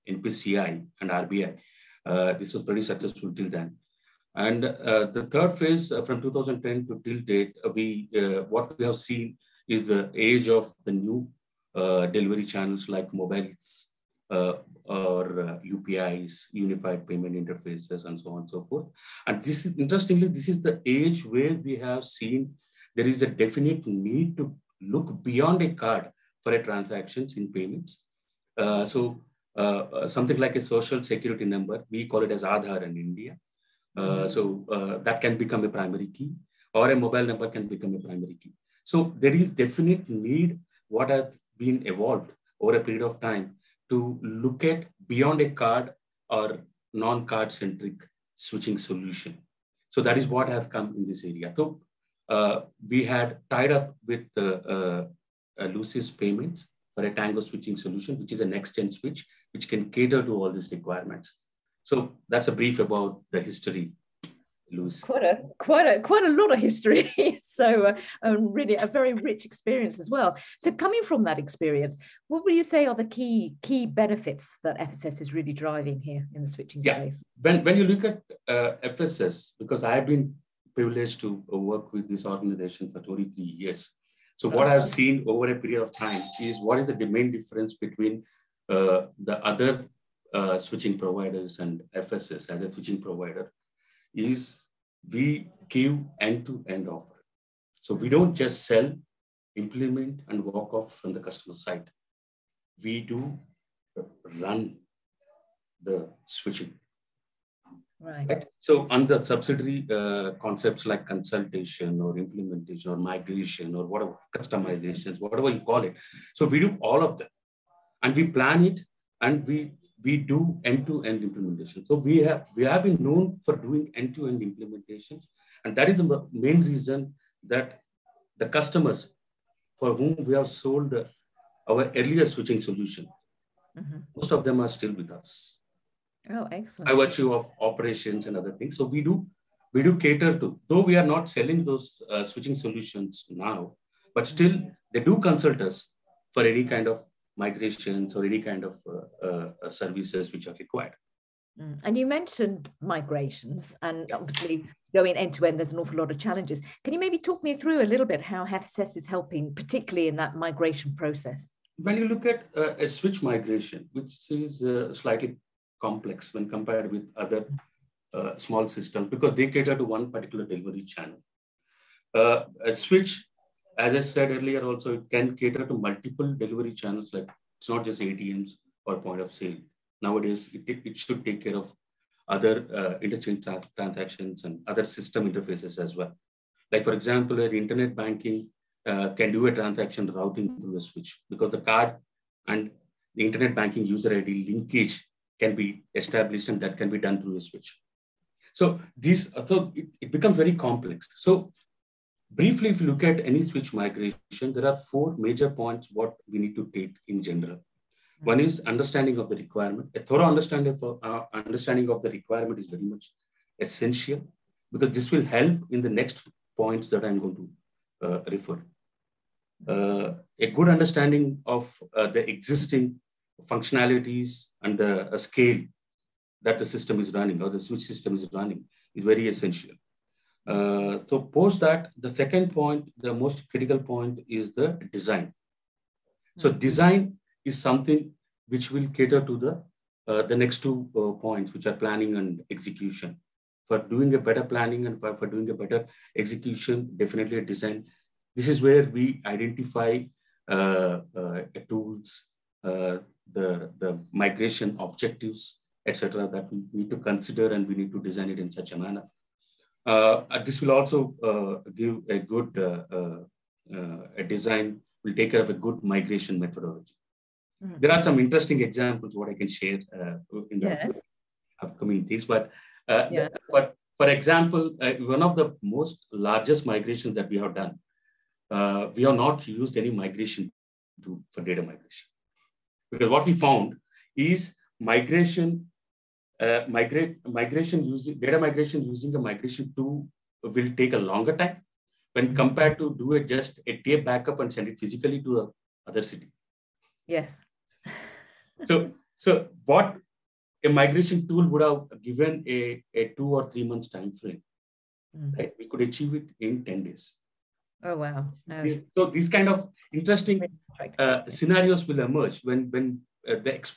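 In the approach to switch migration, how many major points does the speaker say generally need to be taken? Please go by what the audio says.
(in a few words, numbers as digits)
4.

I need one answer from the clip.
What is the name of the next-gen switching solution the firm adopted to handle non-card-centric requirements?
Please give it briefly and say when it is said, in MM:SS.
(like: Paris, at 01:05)
Tango, at 00:57.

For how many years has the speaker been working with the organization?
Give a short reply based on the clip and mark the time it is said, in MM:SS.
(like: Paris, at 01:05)
23 years, at 01:22.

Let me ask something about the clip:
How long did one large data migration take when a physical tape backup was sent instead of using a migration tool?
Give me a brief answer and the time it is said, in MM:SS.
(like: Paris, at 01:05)
10 days, at 05:06.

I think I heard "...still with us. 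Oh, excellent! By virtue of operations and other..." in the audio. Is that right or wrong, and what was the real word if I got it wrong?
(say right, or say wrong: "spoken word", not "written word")
right.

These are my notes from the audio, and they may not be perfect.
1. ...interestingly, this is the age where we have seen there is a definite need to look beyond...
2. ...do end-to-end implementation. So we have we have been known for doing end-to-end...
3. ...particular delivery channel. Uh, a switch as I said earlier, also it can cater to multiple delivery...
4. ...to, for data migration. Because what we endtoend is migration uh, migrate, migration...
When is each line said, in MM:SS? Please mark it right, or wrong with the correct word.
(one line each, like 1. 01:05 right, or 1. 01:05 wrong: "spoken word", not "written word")
1. 00:19 right
2. 02:00 right
3. 02:50 right
4. 04:41 wrong: "found", not "endtoend".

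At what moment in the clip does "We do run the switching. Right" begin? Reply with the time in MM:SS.
01:42.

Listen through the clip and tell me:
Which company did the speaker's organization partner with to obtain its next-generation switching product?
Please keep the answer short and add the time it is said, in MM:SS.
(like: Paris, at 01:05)
Lusis Payments, at 00:55.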